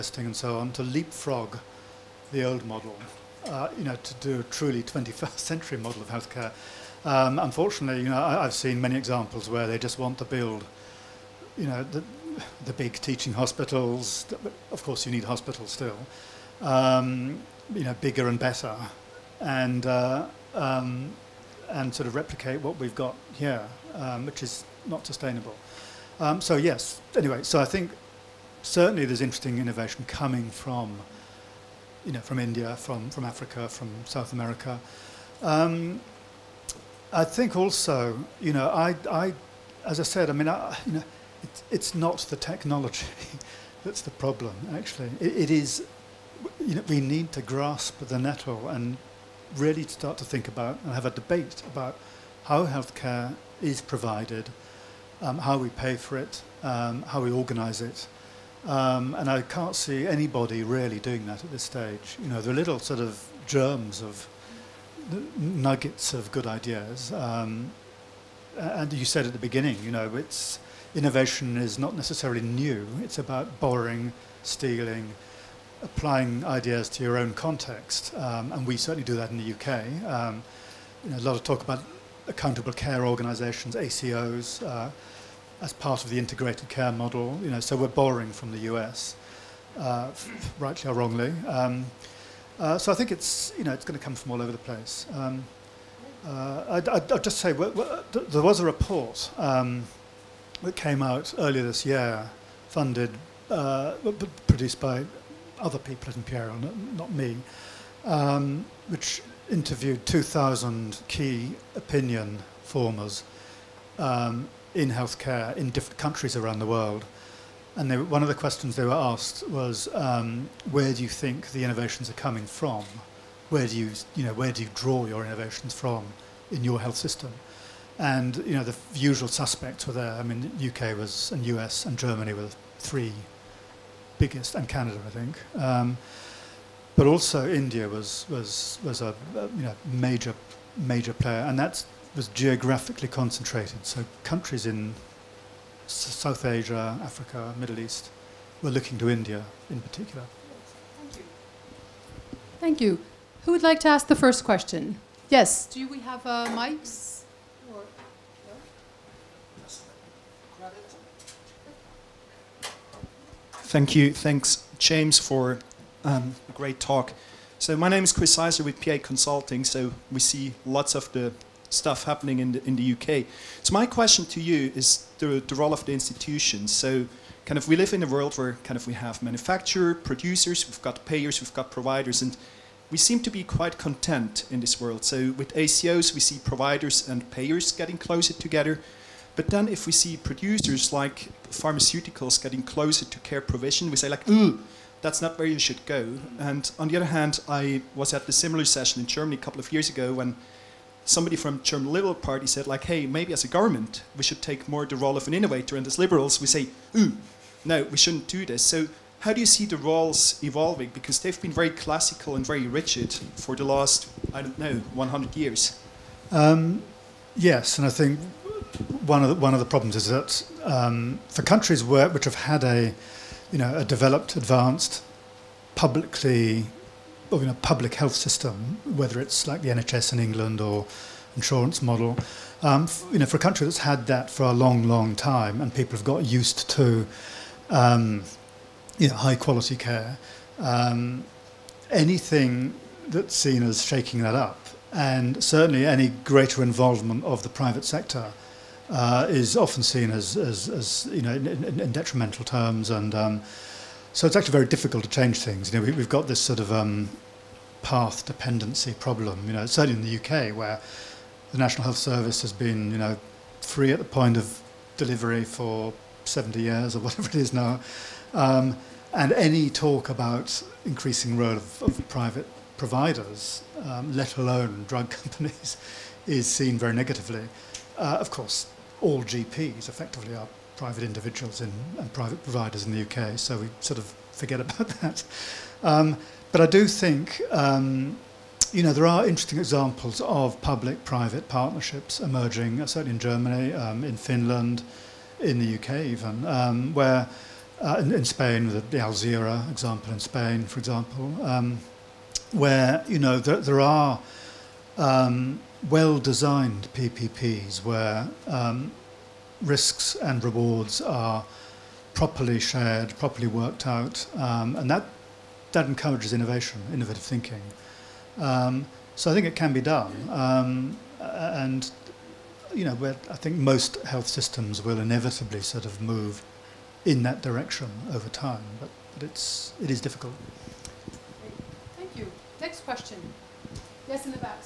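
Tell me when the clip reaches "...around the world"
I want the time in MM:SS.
01:56.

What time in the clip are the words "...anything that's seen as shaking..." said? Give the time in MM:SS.
04:01.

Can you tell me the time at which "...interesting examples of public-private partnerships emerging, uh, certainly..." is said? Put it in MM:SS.
04:49.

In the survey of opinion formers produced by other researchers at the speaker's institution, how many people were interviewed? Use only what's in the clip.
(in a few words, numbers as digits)
2,000.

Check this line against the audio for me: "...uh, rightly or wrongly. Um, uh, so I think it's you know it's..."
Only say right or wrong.
right.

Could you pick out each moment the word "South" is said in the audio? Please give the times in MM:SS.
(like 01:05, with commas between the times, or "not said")
00:34, 02:25.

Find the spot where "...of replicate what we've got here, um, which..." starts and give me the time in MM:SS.
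00:22.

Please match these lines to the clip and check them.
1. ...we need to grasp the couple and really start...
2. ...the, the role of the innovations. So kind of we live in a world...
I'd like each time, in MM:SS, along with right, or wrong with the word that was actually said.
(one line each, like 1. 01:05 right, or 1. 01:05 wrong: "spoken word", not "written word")
1. 00:46 wrong: "nettle", not "couple"
2. 02:55 wrong: "institutions", not "innovations".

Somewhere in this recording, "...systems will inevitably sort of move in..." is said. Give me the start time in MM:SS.
05:24.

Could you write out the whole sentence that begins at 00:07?
Um, unfortunately, you know, I, have seen many examples where they just want to build, you know, the, the big teaching hospitals.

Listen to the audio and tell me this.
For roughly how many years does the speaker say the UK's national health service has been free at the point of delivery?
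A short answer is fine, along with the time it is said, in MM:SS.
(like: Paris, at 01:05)
70, at 04:26.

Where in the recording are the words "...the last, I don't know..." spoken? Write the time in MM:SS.
03:33.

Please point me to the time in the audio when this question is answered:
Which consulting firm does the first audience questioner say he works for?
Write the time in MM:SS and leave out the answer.
02:48.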